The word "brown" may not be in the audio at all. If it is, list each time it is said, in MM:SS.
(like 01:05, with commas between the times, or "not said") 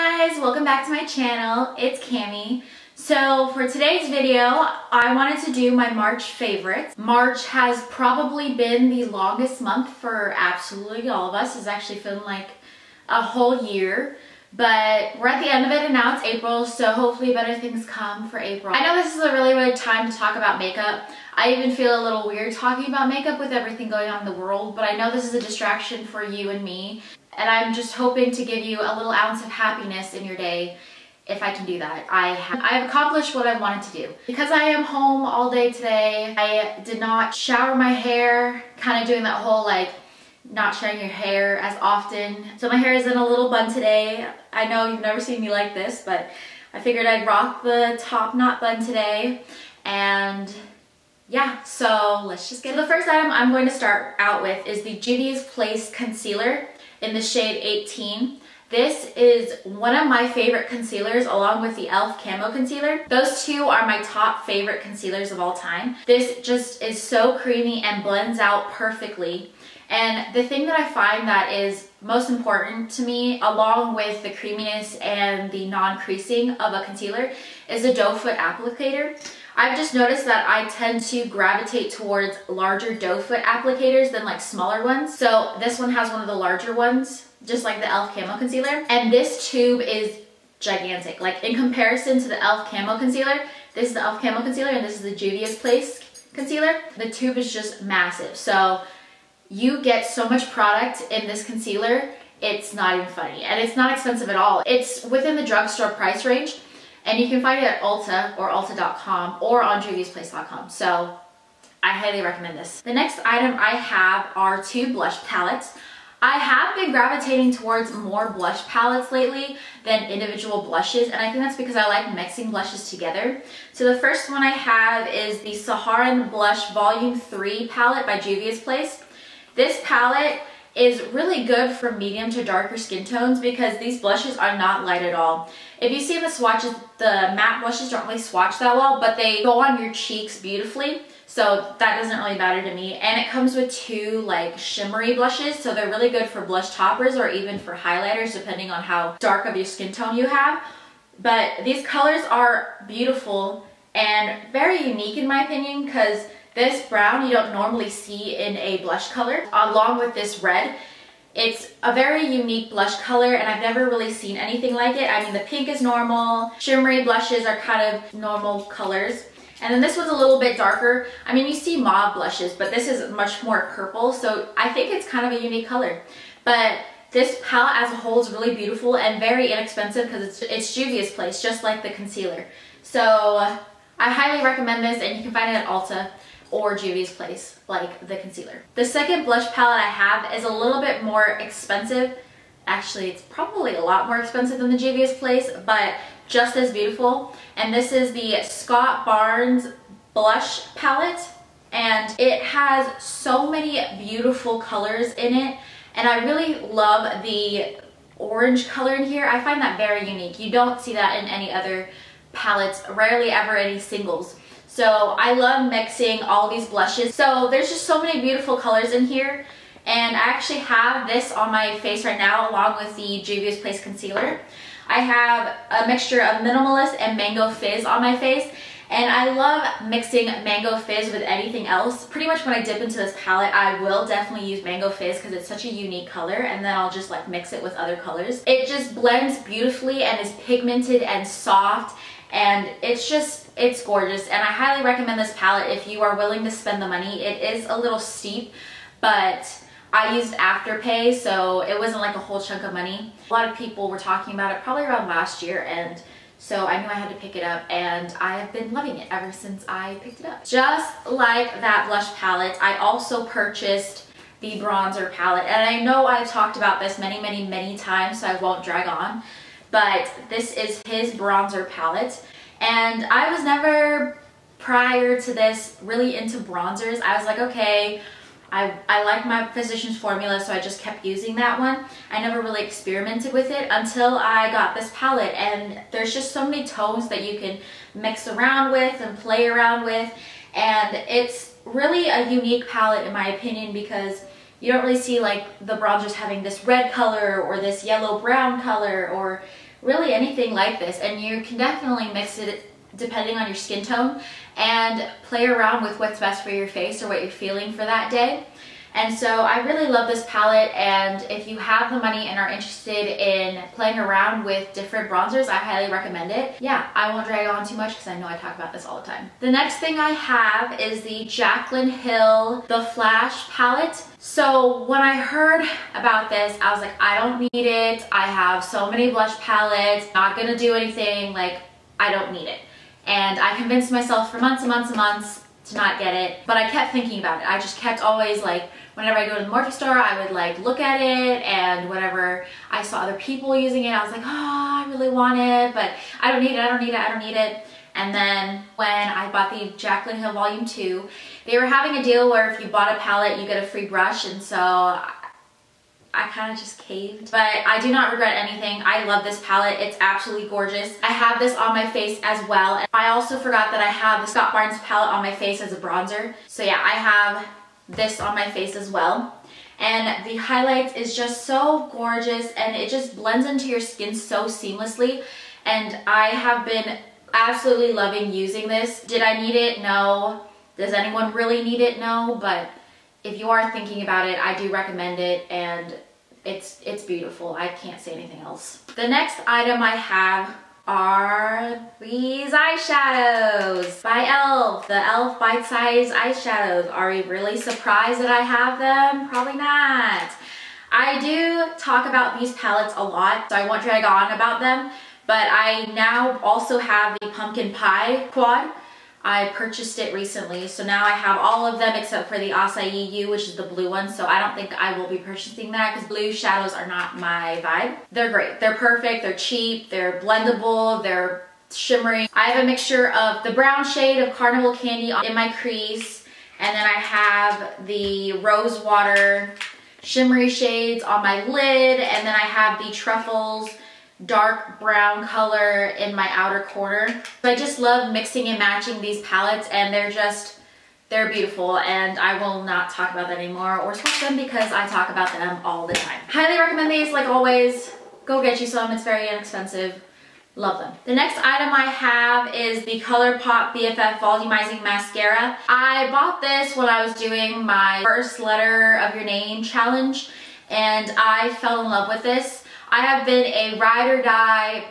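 02:36, 04:58, 07:03, 07:14.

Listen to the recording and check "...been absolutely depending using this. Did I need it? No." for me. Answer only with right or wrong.
wrong.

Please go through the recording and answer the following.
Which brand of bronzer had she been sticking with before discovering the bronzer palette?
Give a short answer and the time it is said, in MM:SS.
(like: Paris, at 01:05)
Physician's Formula, at 04:39.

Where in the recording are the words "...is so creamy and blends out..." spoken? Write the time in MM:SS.
01:06.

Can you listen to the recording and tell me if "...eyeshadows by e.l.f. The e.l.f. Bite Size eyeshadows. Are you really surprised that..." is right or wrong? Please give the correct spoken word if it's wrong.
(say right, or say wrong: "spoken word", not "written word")
right.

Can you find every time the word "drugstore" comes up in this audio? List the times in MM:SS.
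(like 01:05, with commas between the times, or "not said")
01:45.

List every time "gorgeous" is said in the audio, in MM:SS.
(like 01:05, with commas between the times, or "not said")
04:03, 06:00, 06:11.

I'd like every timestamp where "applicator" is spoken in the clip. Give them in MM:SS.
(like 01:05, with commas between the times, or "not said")
01:18, 01:23.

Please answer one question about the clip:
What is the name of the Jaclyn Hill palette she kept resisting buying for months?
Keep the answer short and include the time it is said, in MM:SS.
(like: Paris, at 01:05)
The Flash, at 05:22.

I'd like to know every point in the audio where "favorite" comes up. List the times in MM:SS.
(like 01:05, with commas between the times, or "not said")
00:06, 01:00, 01:04.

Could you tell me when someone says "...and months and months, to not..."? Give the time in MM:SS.
05:34.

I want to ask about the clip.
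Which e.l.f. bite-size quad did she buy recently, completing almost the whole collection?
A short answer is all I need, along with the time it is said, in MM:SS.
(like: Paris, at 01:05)
Pumpkin Pie, at 06:47.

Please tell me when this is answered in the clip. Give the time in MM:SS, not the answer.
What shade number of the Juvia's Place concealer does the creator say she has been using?
00:57.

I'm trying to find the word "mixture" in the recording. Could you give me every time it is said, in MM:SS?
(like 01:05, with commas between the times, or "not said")
03:45, 07:02.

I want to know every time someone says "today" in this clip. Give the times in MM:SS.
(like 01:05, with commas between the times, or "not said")
00:03, 00:35, 00:43, 00:48.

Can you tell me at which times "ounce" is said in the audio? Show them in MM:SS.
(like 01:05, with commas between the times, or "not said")
00:29.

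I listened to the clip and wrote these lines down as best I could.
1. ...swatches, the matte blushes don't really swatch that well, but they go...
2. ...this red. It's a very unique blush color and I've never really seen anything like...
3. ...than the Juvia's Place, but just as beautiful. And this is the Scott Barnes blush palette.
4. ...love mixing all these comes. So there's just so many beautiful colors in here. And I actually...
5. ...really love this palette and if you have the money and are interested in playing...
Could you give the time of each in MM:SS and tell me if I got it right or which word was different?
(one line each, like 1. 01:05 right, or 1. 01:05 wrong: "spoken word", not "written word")
1. 02:16 right
2. 02:40 right
3. 03:14 right
4. 03:35 wrong: "blushes", not "comes"
5. 05:09 right.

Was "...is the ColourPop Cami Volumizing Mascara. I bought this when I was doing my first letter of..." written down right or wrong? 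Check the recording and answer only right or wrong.
wrong.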